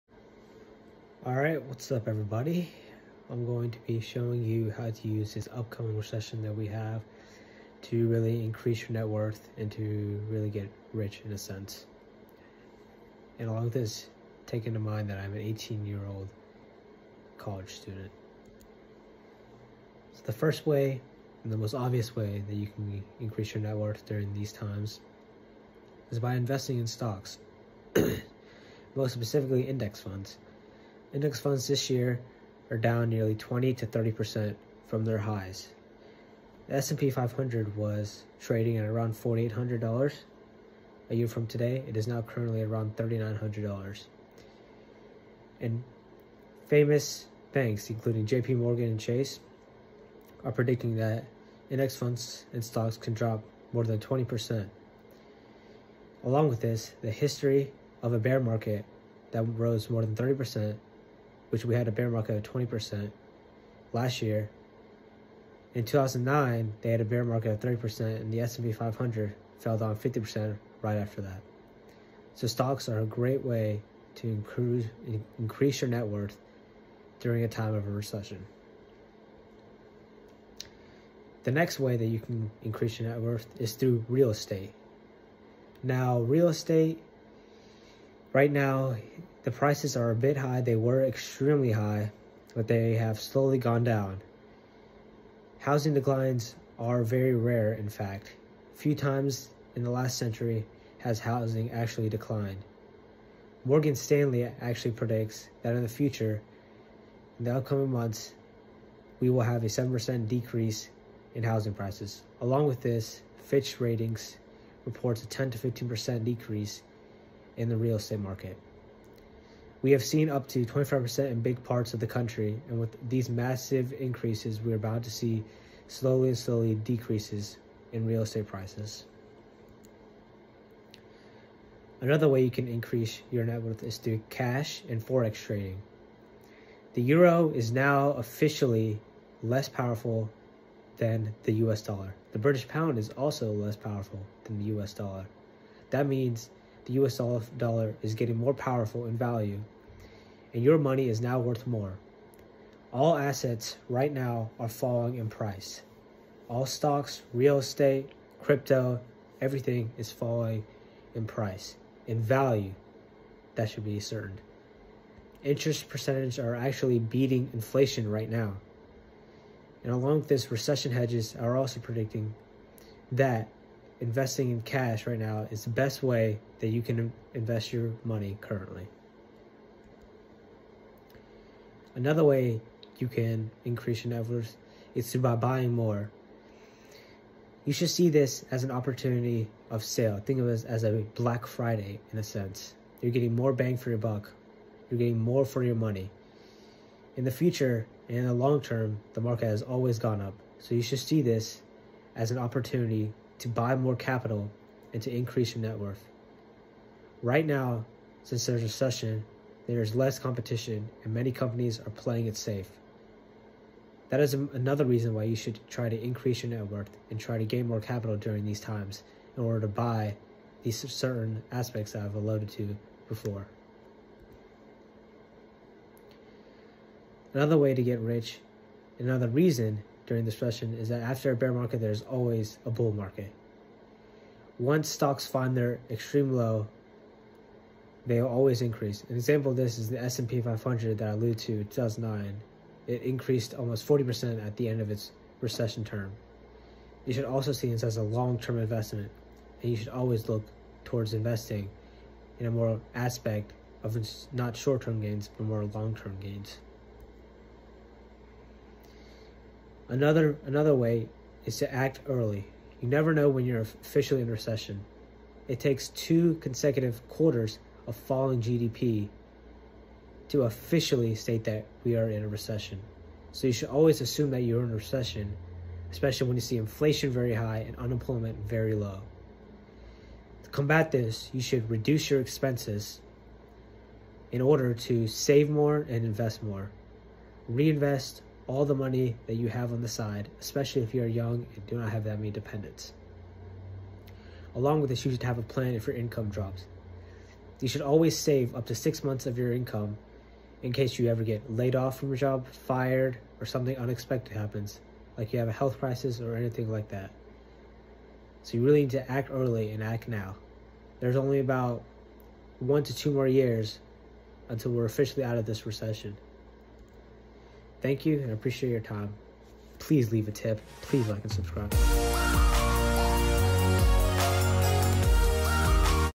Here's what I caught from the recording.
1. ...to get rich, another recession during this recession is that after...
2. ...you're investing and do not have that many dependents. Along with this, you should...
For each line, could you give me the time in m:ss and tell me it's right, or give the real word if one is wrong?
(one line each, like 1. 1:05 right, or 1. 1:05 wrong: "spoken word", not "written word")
1. 3:47 wrong: "reason", not "recession"
2. 4:50 wrong: "young", not "investing".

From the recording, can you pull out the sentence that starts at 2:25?
That means the US dollar is getting more powerful in value, and your money is now worth more.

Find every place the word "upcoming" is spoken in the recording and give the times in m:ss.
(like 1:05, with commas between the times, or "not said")
0:05, 1:47.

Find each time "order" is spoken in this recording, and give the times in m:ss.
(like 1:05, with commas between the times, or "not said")
3:39, 4:44.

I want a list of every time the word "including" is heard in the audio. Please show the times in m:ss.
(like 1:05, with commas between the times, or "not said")
0:47.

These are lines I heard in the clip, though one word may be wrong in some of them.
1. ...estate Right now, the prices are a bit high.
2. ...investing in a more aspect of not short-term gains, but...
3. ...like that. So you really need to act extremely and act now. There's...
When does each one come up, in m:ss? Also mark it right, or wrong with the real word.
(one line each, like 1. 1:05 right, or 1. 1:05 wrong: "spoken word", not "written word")
1. 1:26 right
2. 4:11 right
3. 5:06 wrong: "early", not "extremely".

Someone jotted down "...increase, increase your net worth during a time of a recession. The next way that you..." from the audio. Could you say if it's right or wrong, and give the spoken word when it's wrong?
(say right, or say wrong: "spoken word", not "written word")
right.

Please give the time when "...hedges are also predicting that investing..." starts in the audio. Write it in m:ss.
2:50.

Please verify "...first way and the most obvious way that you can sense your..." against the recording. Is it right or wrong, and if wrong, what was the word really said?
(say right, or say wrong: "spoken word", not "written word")
wrong: "increase", not "sense".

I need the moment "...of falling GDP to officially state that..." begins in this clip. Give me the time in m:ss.
4:27.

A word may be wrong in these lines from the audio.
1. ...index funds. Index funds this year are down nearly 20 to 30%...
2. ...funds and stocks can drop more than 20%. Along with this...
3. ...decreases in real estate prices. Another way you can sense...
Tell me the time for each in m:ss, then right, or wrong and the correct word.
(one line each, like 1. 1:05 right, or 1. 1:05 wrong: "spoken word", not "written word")
1. 0:29 right
2. 0:51 right
3. 2:06 wrong: "increase", not "sense".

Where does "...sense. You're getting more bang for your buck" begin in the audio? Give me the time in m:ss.
3:12.